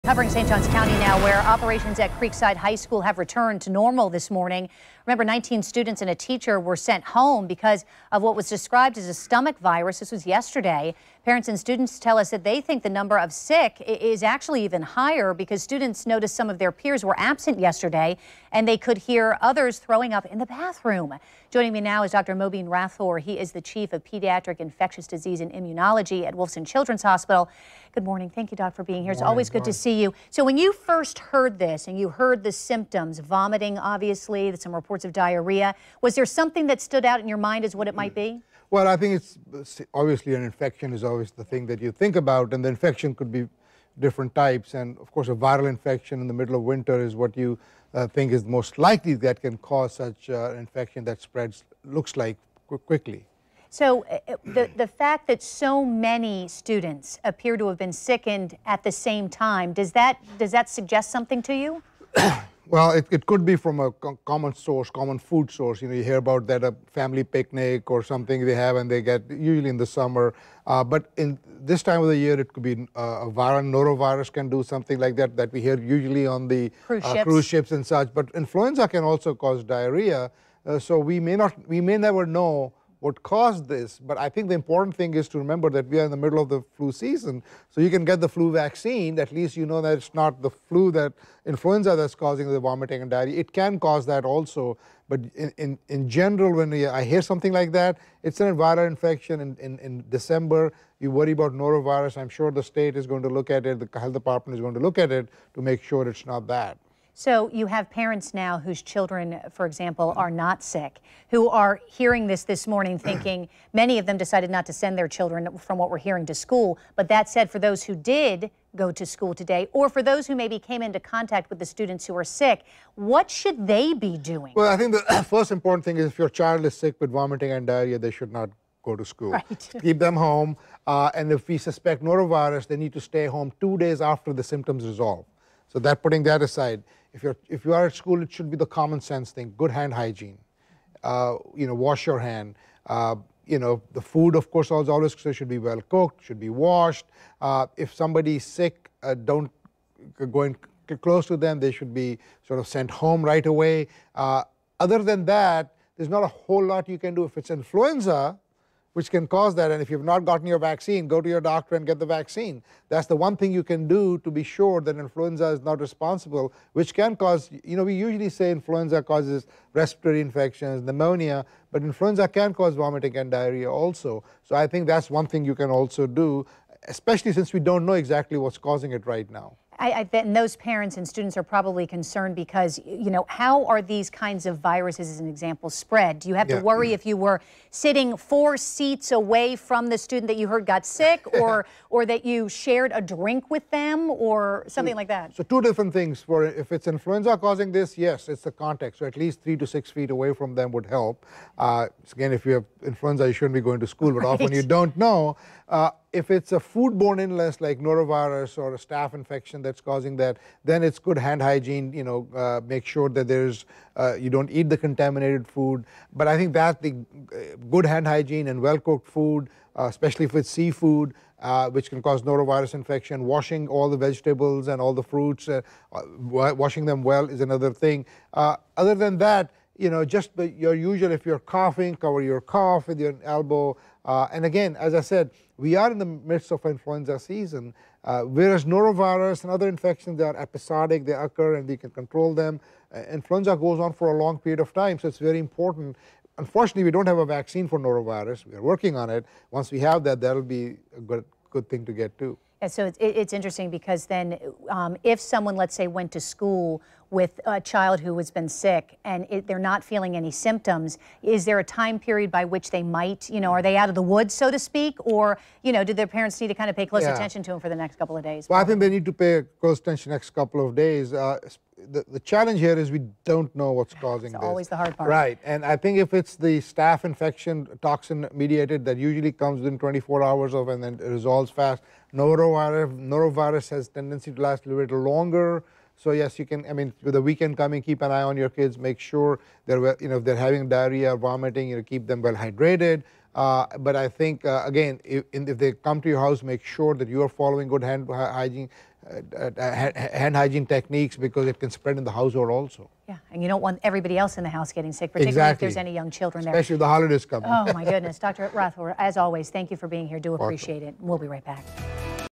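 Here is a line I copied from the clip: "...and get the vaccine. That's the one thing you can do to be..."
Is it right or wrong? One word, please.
right.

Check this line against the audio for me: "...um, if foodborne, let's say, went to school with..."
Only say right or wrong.
wrong.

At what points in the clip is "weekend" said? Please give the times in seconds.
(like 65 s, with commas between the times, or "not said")
287 s.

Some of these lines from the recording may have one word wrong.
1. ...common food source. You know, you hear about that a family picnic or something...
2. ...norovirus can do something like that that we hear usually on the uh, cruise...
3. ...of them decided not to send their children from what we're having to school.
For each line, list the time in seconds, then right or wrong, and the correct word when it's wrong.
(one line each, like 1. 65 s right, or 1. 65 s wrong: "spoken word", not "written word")
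1. 64 s right
2. 73 s right
3. 113 s wrong: "hearing", not "having".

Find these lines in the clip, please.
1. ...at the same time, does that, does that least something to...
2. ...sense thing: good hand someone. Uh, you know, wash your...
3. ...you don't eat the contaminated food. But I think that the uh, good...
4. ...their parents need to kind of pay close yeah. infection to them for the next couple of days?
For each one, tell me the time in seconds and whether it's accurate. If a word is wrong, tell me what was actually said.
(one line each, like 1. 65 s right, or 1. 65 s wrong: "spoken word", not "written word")
1. 58 s wrong: "suggest", not "least"
2. 139 s wrong: "hygiene", not "someone"
3. 214 s right
4. 265 s wrong: "attention", not "infection".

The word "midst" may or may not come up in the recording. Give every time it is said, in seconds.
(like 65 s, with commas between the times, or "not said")
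236 s.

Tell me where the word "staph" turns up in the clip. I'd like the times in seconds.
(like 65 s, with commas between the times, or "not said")
208 s, 276 s.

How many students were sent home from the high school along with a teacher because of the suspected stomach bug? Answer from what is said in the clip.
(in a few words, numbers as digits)
19.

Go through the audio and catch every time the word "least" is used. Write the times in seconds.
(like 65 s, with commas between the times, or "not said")
89 s, 199 s.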